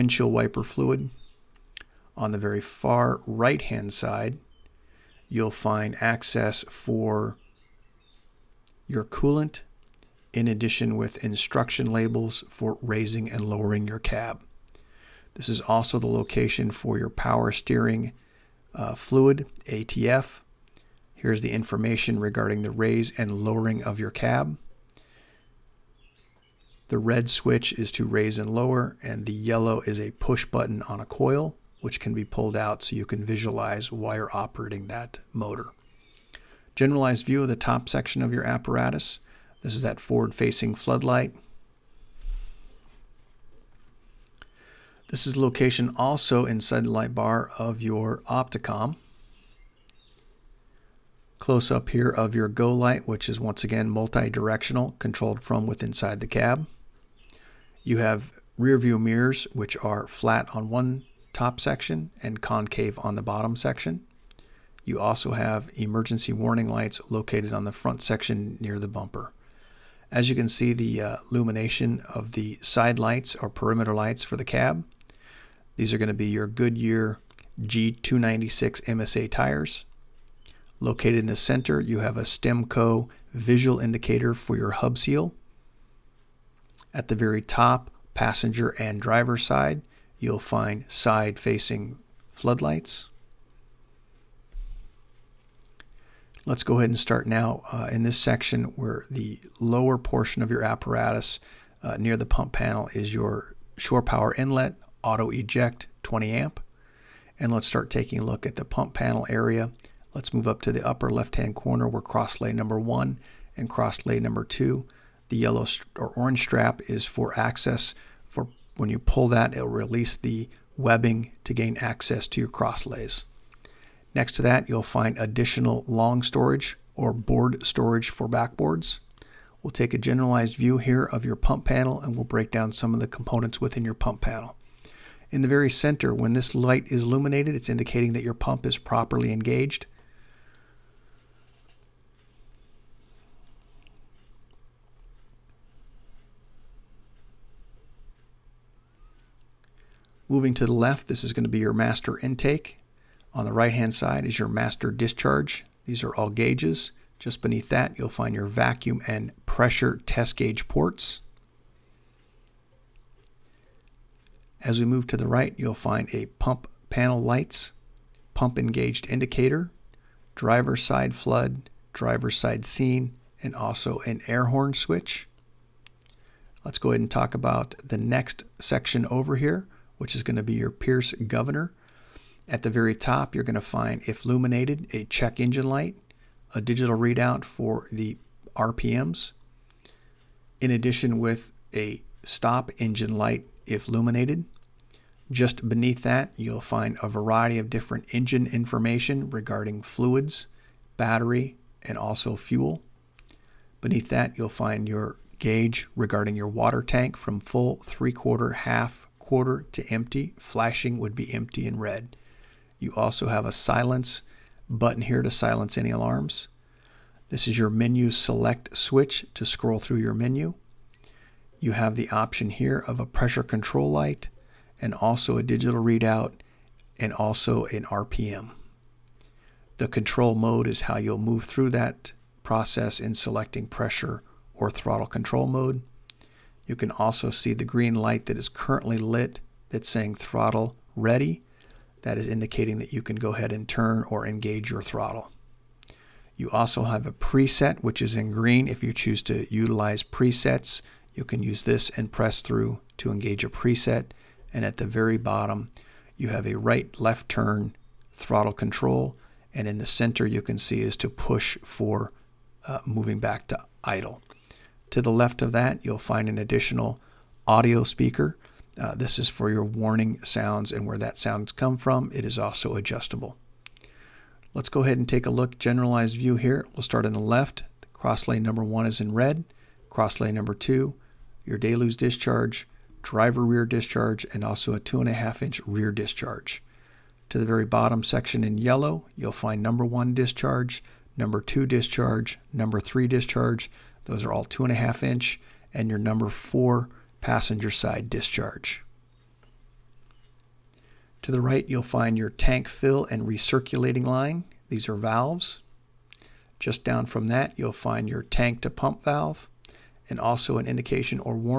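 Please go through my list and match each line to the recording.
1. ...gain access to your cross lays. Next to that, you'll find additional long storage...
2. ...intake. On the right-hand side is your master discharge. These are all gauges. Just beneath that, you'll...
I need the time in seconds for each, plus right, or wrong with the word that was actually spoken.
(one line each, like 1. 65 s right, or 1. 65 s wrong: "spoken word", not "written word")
1. 121 s right
2. 152 s right.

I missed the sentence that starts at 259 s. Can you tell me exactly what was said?
And in the center, you can see is to push for uh, moving back to idle.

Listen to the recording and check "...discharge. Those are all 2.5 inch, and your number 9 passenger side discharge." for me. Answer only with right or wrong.
wrong.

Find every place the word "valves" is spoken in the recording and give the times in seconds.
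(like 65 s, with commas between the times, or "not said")
304 s, 309 s.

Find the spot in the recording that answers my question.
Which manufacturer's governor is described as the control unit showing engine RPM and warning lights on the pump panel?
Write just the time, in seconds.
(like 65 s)
180 s.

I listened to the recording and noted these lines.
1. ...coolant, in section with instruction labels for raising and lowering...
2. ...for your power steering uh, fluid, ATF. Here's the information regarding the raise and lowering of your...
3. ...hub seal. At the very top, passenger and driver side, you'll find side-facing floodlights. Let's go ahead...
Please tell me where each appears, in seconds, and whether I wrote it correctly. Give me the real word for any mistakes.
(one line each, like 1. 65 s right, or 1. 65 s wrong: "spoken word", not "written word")
1. 9 s wrong: "addition", not "section"
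2. 16 s right
3. 84 s right.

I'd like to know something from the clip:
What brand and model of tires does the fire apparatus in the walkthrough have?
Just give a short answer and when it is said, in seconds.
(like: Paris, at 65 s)
Goodyear G296 MSA, at 76 s.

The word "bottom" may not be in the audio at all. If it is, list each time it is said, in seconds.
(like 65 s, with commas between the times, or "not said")
63 s, 255 s, 287 s.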